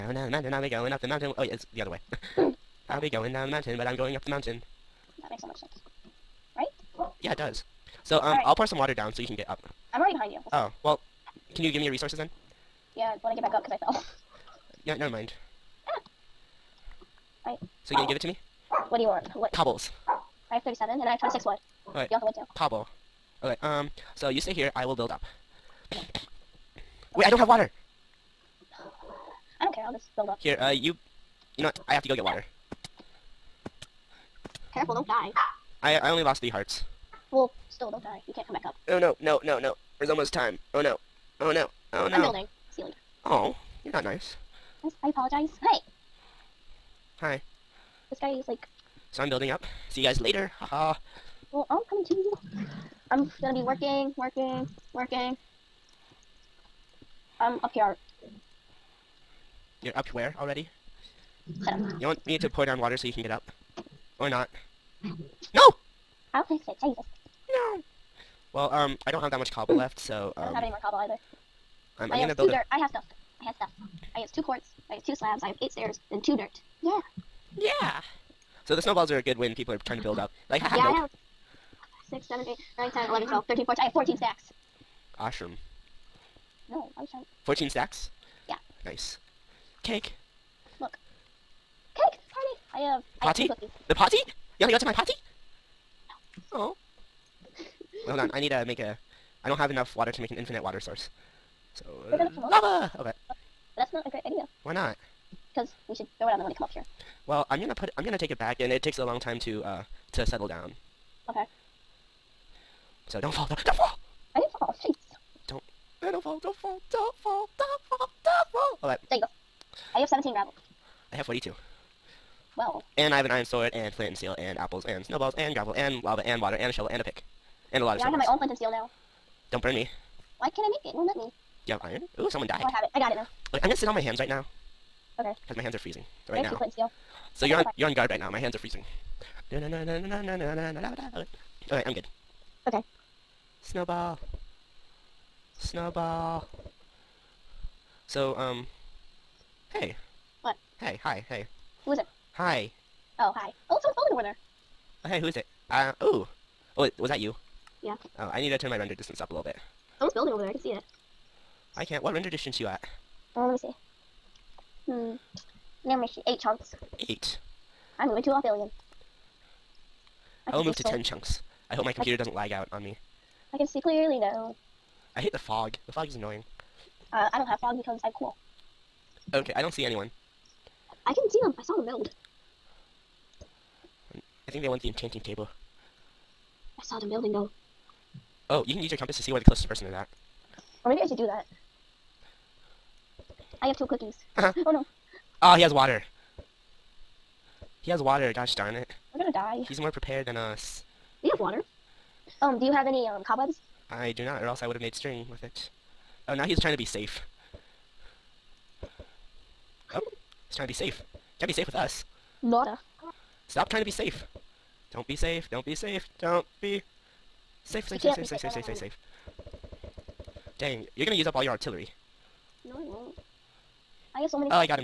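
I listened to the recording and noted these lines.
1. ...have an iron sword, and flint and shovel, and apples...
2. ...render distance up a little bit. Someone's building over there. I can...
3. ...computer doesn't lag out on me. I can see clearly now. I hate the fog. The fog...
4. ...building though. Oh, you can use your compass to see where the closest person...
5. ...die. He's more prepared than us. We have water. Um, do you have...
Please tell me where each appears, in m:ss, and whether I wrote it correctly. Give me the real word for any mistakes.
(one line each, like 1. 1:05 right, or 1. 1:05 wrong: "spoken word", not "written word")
1. 2:03 wrong: "steel", not "shovel"
2. 2:38 right
3. 2:51 right
4. 3:07 right
5. 3:19 right.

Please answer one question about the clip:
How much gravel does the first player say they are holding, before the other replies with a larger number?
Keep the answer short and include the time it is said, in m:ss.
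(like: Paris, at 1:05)
17, at 2:00.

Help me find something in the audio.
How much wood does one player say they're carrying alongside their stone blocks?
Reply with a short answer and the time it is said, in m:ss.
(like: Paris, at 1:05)
26, at 0:21.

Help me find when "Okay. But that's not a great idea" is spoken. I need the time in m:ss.
1:42.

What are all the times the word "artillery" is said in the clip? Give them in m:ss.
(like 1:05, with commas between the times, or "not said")
3:41.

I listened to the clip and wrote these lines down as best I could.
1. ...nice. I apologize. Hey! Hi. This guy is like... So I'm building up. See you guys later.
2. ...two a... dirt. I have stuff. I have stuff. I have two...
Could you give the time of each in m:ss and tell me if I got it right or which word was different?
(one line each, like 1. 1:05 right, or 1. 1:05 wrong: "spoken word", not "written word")
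1. 0:44 right
2. 1:12 right.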